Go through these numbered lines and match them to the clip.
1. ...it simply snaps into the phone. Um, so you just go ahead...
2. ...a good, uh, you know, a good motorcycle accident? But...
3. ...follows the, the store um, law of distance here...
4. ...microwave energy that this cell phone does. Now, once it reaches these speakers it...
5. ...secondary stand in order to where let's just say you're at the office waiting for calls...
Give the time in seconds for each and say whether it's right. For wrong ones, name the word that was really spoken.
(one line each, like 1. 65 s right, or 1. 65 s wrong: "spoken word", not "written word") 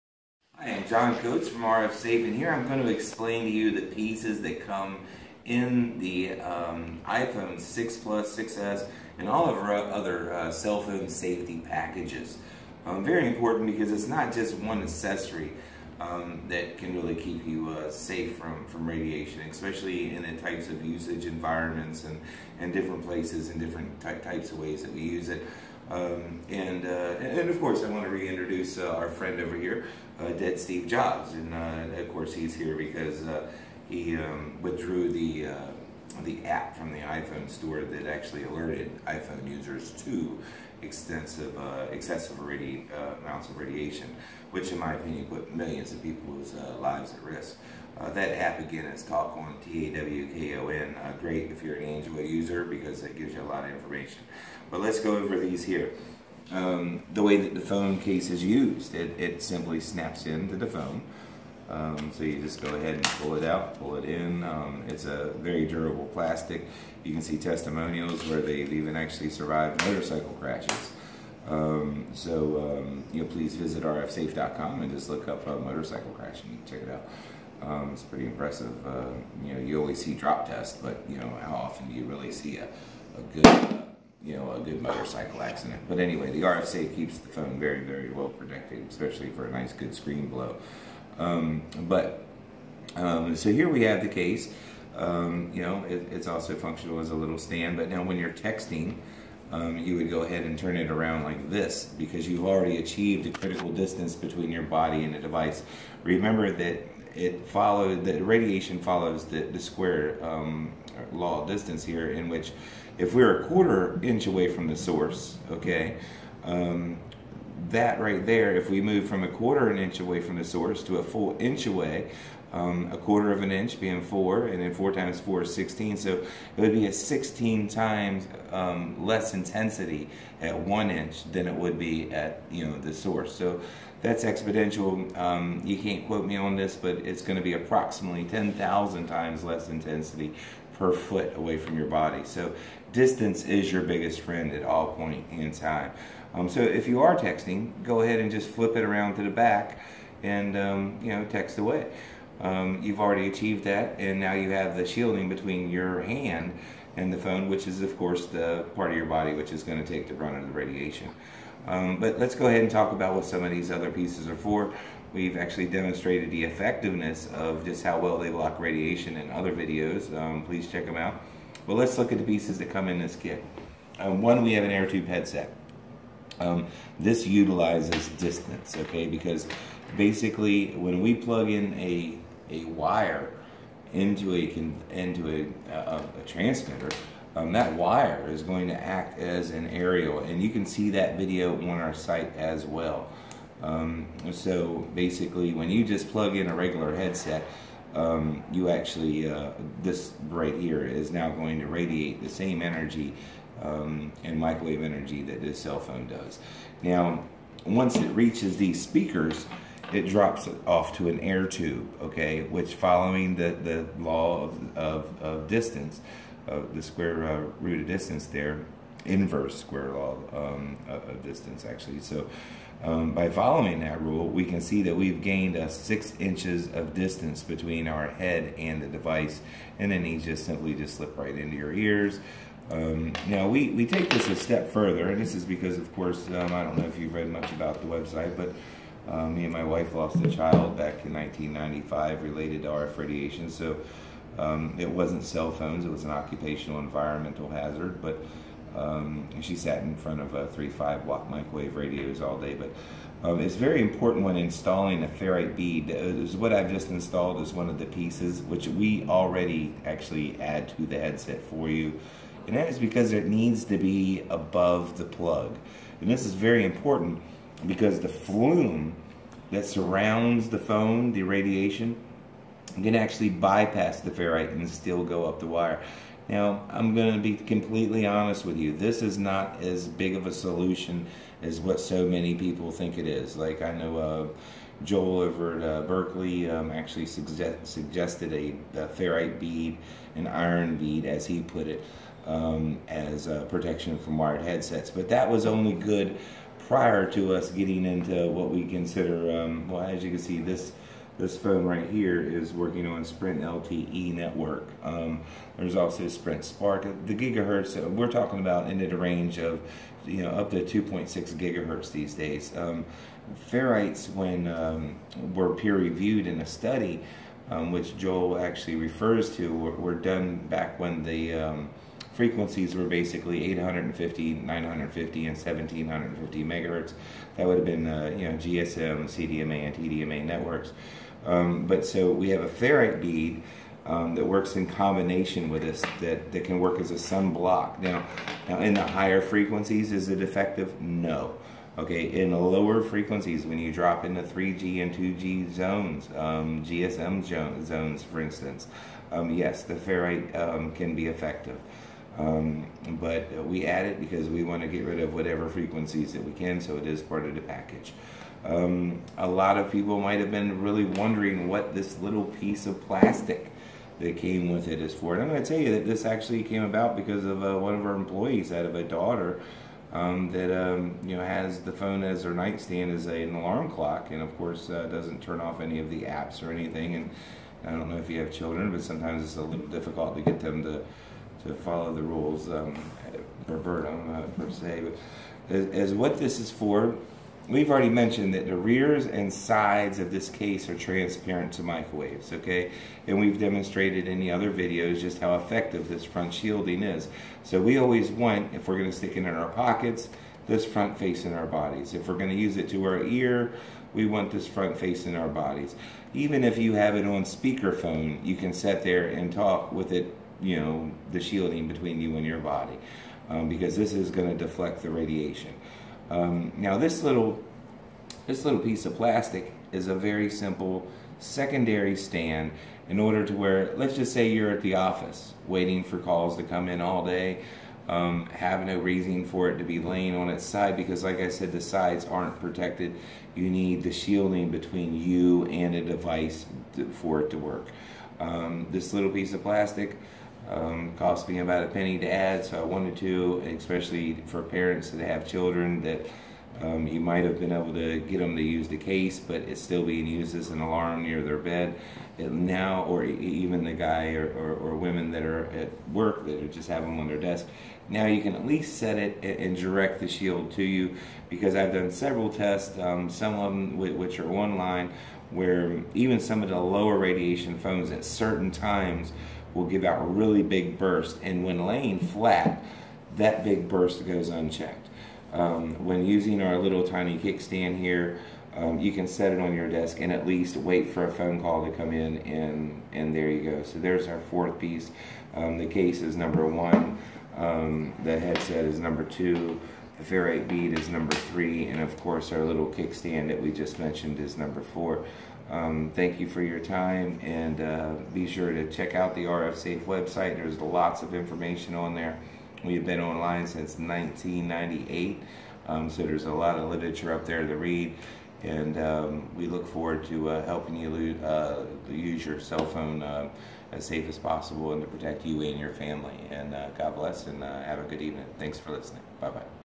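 1. 59 s right
2. 83 s right
3. 108 s wrong: "square", not "store"
4. 204 s right
5. 421 s right.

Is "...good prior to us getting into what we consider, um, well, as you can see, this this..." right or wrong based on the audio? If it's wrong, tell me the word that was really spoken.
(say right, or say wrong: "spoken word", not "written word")
right.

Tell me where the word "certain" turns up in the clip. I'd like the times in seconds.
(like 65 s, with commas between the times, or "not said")
468 s.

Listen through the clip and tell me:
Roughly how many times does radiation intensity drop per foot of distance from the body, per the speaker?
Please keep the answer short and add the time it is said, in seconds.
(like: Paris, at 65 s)
10,000, at 138 s.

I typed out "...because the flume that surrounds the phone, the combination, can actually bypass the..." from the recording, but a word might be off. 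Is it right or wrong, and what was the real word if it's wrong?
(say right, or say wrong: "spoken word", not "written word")
wrong: "radiation", not "combination".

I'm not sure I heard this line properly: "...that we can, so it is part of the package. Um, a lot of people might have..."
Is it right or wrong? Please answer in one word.
right.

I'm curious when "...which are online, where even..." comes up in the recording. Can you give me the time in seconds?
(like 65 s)
463 s.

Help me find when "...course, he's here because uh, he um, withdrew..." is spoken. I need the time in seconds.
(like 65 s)
32 s.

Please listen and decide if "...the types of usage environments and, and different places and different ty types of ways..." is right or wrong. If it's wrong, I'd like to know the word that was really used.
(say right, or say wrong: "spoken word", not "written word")
right.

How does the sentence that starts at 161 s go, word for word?
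Um, but let's go ahead and talk about what some of these other pieces are for.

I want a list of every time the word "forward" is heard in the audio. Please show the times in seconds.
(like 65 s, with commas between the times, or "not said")
509 s.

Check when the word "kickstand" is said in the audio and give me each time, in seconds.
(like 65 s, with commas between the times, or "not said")
477 s, 492 s.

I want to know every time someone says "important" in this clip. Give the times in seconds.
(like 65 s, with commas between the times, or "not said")
13 s, 253 s, 266 s.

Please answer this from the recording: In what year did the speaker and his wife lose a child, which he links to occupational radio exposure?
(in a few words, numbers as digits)
1995.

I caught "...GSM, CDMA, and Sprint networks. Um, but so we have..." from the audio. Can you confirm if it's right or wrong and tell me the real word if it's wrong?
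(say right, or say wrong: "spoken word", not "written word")
wrong: "TDMA", not "Sprint".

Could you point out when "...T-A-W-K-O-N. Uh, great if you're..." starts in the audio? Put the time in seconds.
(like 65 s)
49 s.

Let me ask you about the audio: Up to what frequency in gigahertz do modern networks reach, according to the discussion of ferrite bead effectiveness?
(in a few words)
2.6 gigahertz.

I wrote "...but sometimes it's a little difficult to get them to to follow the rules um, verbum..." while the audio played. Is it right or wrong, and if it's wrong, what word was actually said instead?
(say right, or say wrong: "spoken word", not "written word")
right.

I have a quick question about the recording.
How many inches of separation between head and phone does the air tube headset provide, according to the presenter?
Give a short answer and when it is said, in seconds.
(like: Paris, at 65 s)
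6, at 225 s.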